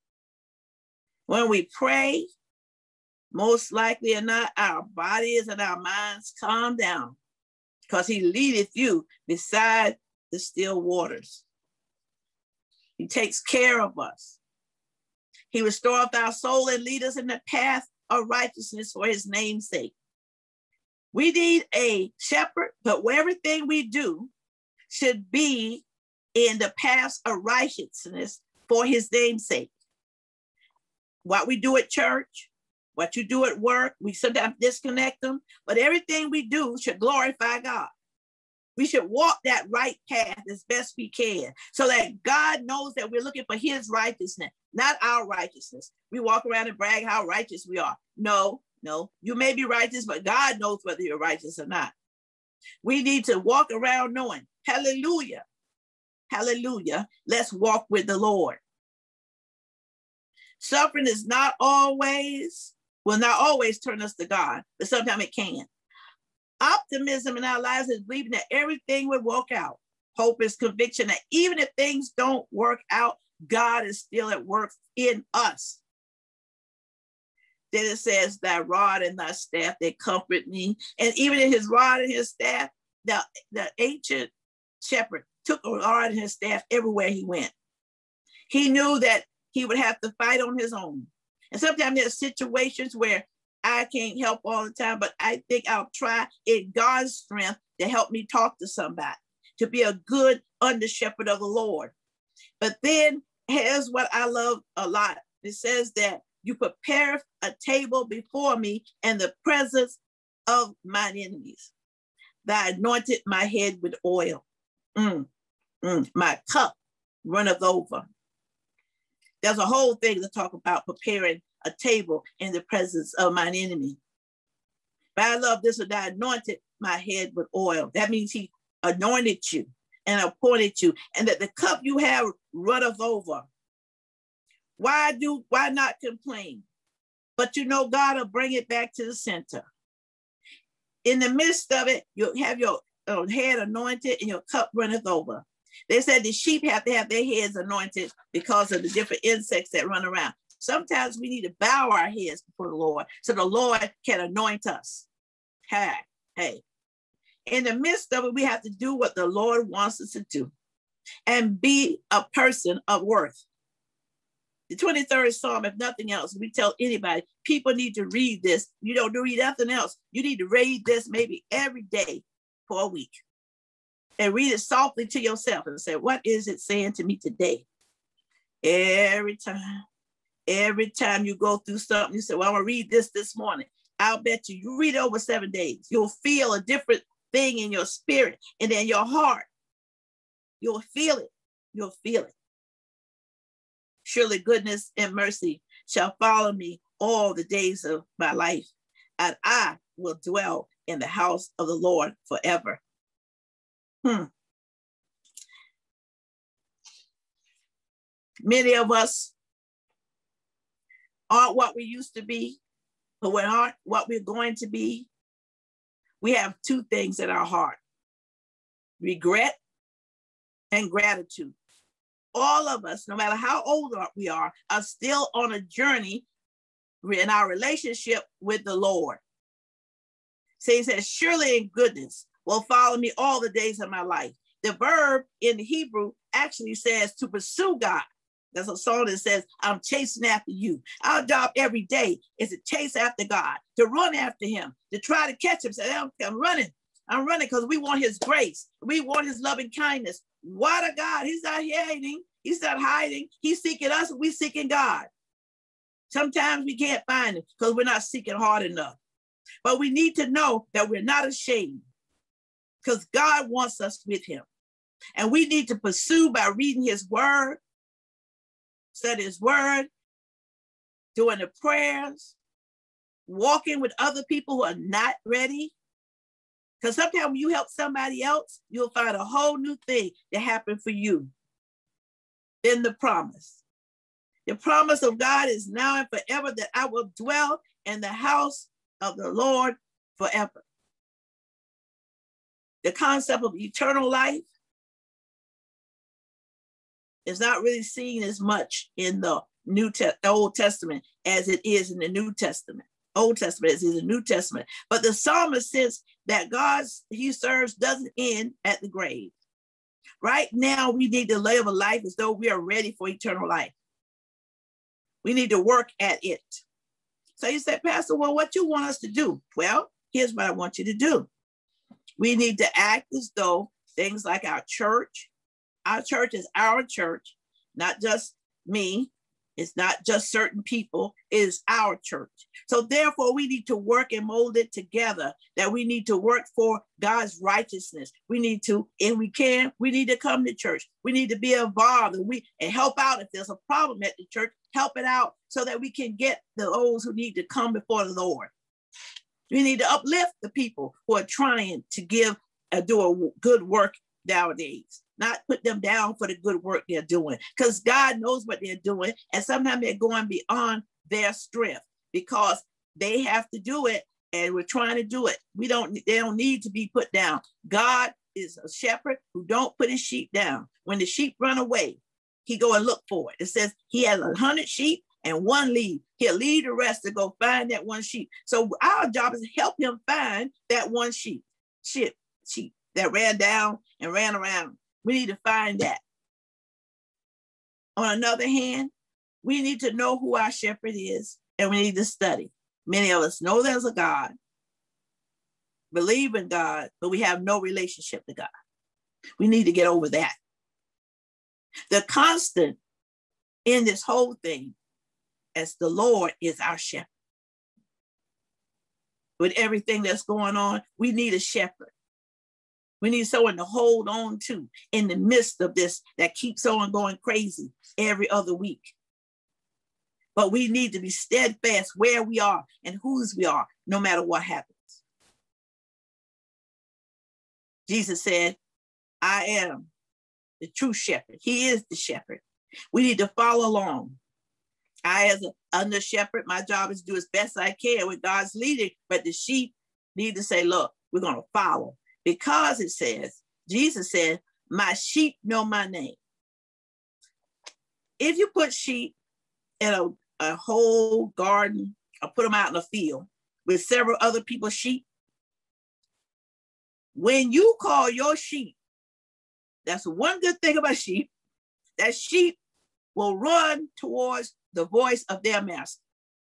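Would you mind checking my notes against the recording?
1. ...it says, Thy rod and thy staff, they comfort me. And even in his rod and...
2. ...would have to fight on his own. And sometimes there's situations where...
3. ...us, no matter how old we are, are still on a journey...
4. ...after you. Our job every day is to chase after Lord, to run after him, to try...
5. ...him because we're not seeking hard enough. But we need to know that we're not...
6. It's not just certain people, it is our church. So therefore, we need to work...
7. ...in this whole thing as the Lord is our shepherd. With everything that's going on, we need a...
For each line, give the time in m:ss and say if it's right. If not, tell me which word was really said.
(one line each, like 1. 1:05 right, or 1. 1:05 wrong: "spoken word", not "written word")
1. 1:17 right
2. 1:29 right
3. 3:42 right
4. 4:00 wrong: "God", not "Lord"
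5. 4:17 right
6. 5:29 right
7. 6:43 right.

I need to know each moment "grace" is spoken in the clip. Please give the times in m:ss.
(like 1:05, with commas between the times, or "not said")
4:08.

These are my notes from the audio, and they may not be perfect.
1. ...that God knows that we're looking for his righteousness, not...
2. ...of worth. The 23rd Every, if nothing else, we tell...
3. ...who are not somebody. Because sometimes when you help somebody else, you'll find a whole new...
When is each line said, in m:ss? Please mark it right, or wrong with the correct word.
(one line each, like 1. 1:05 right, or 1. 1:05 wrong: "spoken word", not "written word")
1. 0:41 right
2. 2:42 wrong: "Psalm", not "Every"
3. 4:34 wrong: "ready", not "somebody".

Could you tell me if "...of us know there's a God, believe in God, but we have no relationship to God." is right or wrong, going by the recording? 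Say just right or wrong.
right.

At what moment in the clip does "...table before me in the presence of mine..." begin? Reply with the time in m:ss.
1:47.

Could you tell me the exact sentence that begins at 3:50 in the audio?
So he says, Surely in goodness will follow me all the days of my life.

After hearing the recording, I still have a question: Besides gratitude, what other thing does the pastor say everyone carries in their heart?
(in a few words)
Regret.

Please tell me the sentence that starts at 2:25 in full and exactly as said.
They said the sheep have to have their heads anointed because of the different insects that run around.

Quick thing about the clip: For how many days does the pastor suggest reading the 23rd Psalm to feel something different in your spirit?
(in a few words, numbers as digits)
7.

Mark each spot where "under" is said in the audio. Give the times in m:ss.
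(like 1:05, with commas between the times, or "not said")
1:40, 7:15.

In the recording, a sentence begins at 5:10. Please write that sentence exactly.
Right now, we need to live a life as though we are ready for eternal life.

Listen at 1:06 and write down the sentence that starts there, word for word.
Optimism in our lives is believing that everything will work out.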